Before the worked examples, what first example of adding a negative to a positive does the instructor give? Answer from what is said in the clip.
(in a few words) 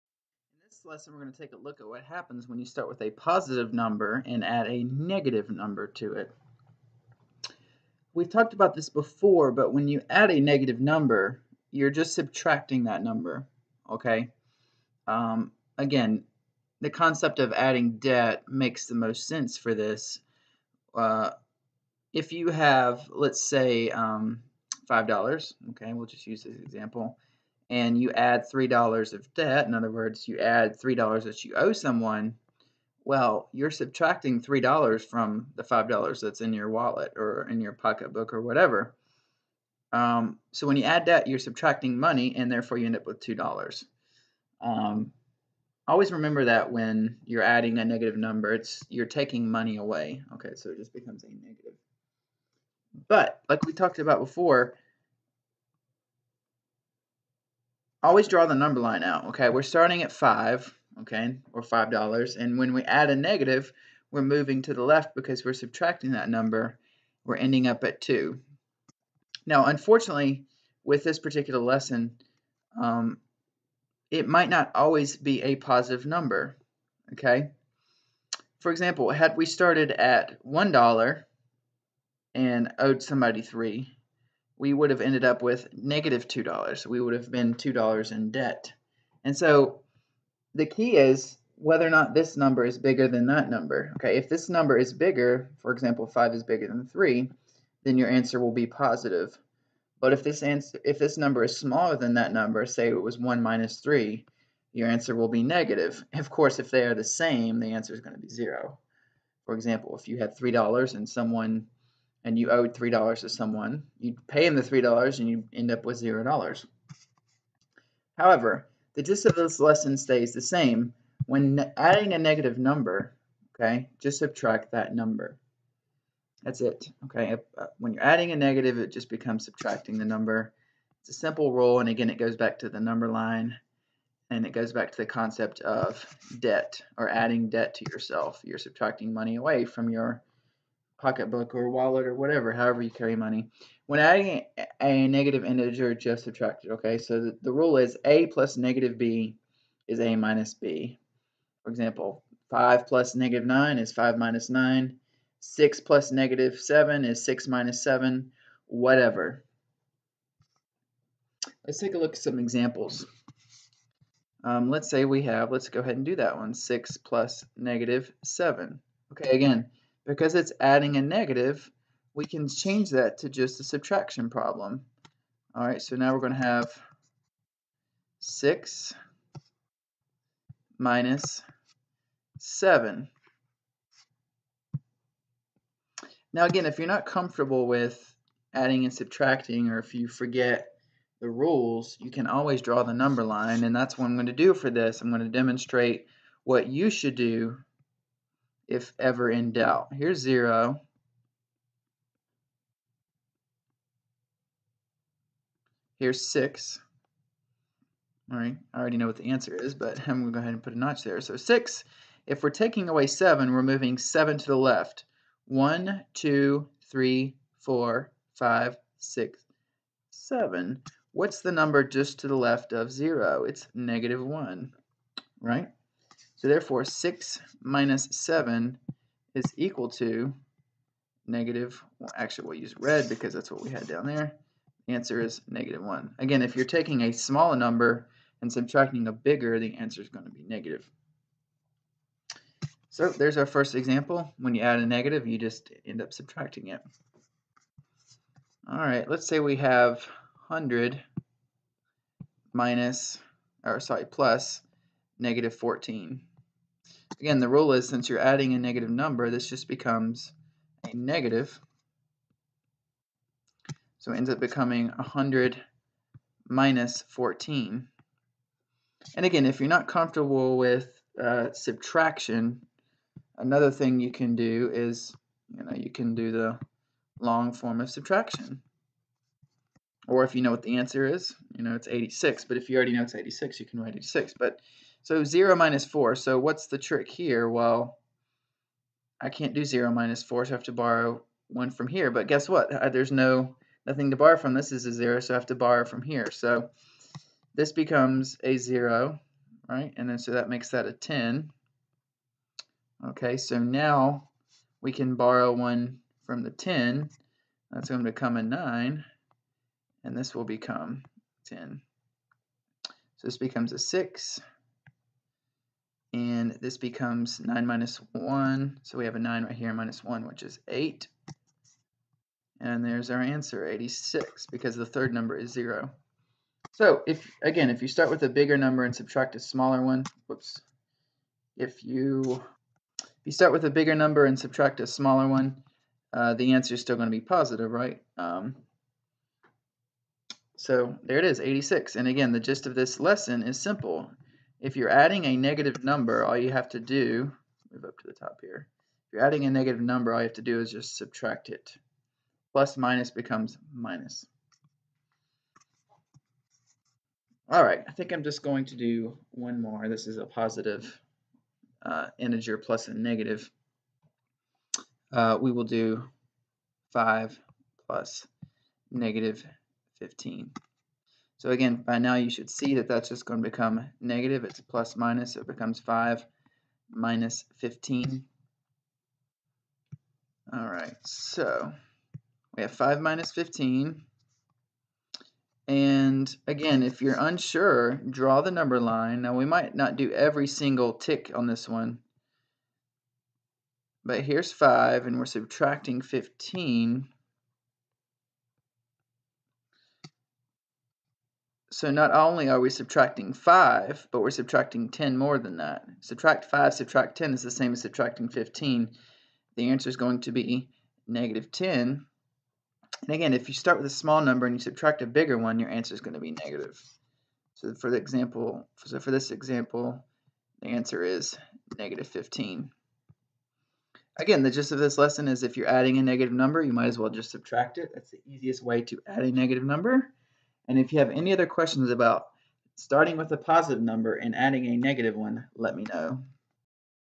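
5 + (-9).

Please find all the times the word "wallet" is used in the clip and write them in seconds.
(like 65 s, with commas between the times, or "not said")
36 s, 141 s.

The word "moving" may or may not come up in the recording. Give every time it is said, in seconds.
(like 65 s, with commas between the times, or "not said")
64 s, 213 s.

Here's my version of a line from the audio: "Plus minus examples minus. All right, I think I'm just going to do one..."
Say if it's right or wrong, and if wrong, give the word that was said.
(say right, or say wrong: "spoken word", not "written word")
wrong: "becomes", not "examples".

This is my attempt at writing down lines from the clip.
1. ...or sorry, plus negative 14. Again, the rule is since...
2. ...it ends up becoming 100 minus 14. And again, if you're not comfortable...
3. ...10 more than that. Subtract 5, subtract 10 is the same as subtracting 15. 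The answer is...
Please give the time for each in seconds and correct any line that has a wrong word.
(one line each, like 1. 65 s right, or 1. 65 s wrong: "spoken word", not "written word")
1. 253 s right
2. 264 s right
3. 404 s right.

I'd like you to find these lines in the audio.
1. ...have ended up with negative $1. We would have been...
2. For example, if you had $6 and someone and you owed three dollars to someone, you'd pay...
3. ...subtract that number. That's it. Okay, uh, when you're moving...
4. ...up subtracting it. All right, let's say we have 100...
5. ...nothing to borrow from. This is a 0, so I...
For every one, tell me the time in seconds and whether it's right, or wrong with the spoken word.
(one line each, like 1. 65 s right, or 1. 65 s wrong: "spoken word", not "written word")
1. 84 s wrong: "2", not "1"
2. 109 s wrong: "3", not "6"
3. 124 s wrong: "adding", not "moving"
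4. 246 s right
5. 293 s right.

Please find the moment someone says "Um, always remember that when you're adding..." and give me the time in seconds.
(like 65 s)
44 s.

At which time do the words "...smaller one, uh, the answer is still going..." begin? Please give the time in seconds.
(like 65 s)
334 s.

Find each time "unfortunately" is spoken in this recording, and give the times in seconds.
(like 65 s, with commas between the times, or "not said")
69 s.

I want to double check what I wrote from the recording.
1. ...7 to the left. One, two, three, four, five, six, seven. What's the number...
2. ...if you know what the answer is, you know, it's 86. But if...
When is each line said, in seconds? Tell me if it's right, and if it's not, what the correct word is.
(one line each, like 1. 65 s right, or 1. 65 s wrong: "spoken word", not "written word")
1. 213 s right
2. 280 s right.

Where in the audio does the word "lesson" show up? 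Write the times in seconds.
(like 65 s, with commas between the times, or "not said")
0 s, 71 s, 119 s, 342 s, 424 s.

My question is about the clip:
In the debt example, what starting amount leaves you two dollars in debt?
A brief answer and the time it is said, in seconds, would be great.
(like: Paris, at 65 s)
$1, at 79 s.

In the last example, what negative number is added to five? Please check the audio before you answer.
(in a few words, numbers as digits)
-15.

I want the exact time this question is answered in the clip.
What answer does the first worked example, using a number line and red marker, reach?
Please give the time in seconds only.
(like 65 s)
234 s.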